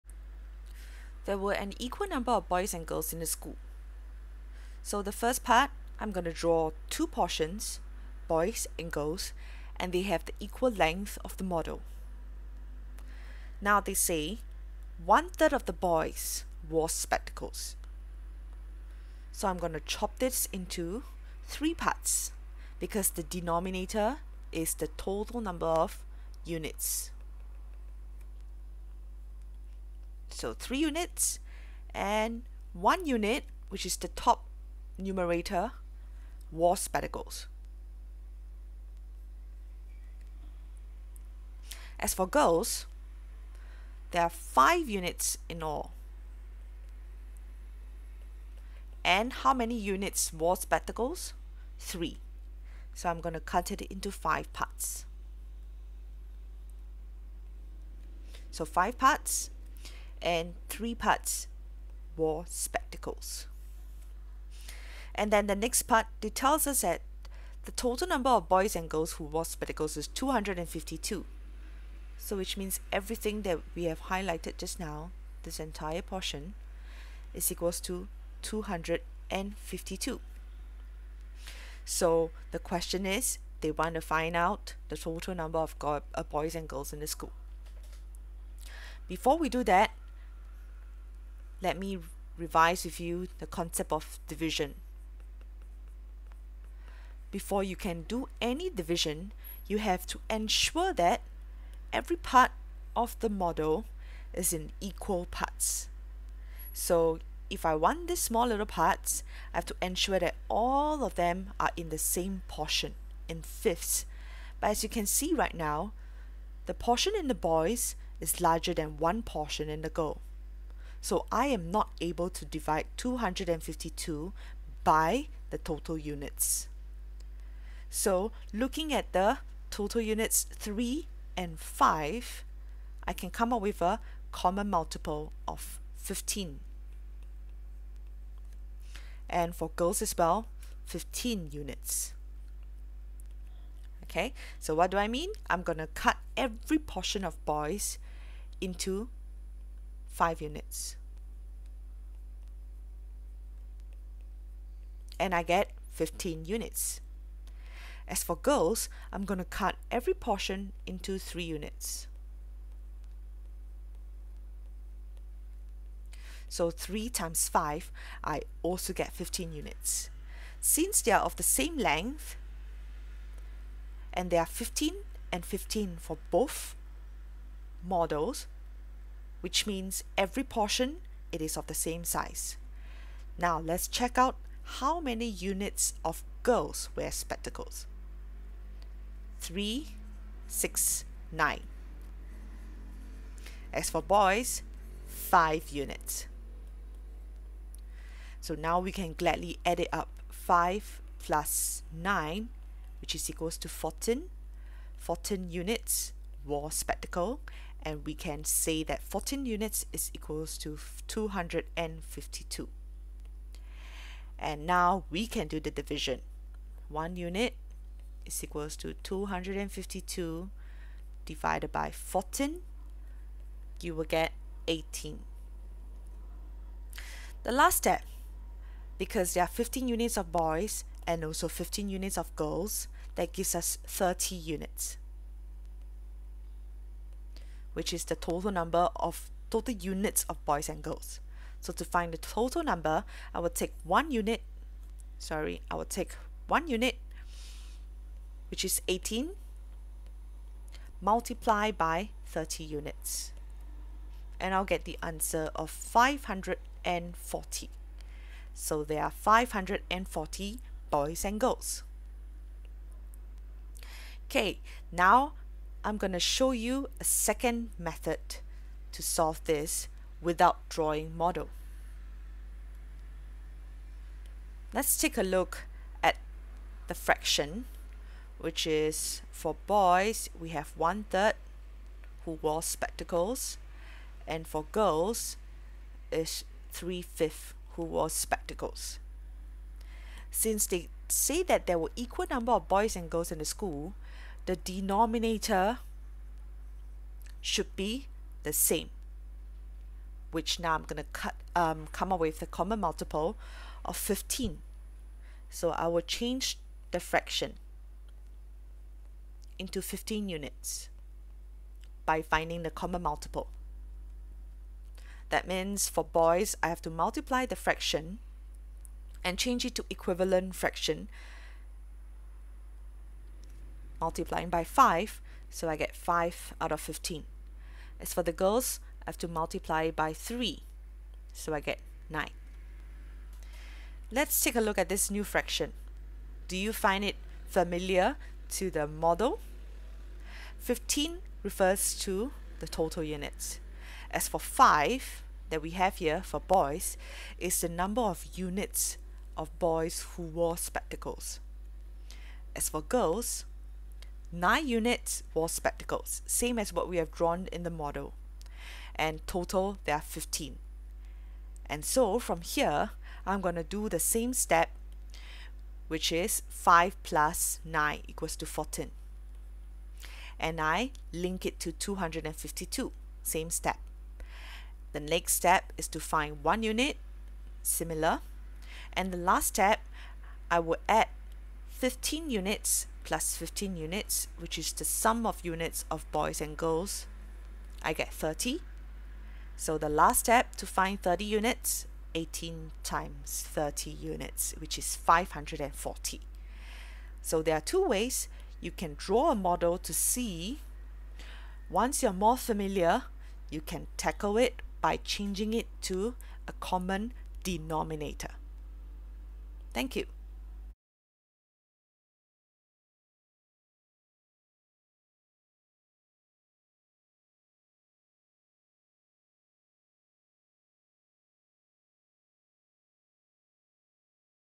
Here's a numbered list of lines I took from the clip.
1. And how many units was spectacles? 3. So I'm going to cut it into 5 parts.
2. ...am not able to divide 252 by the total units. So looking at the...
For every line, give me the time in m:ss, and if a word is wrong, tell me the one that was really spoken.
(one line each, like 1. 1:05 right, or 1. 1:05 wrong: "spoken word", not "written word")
1. 0:49 right
2. 2:01 right.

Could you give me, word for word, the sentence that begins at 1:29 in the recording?
Before we do that, let me revise with you the concept of division.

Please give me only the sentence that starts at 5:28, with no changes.
As for the girls, I have to multiply by 3, so I get 9.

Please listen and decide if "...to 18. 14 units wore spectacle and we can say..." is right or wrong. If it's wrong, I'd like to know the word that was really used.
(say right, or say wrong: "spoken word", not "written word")
wrong: "14", not "18".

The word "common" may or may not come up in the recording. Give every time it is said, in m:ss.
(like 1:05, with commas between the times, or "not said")
2:14, 5:02, 5:12, 6:46.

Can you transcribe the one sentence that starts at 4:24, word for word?
Okay, now I'm going to show you a second method to solve this without drawing model.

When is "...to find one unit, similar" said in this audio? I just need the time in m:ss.
6:15.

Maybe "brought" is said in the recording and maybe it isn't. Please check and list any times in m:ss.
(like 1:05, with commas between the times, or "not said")
not said.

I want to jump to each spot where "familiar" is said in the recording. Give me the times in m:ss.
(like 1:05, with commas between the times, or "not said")
5:37, 6:42.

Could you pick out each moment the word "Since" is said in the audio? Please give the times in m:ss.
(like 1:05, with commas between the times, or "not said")
2:50, 4:50.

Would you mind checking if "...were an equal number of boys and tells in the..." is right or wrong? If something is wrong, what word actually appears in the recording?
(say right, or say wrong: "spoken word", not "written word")
wrong: "girls", not "tells".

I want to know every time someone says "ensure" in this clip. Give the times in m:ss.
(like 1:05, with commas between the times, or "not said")
1:40, 1:49.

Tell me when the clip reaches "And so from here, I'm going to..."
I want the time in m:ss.
6:01.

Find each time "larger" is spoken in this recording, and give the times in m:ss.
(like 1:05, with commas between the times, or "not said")
1:58.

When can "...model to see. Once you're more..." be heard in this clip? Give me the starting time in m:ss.
6:39.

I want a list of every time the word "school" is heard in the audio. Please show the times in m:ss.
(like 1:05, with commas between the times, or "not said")
0:03, 1:27, 4:53.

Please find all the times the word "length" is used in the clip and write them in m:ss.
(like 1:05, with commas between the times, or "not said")
0:10, 2:51.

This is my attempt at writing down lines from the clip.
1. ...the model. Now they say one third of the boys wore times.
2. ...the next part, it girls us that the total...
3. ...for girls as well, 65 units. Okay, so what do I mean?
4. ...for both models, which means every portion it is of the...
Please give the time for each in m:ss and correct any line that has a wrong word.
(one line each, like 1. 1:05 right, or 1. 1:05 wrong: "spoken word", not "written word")
1. 0:11 wrong: "spectacles", not "times"
2. 1:05 wrong: "tells", not "girls"
3. 2:19 wrong: "15", not "65"
4. 2:56 right.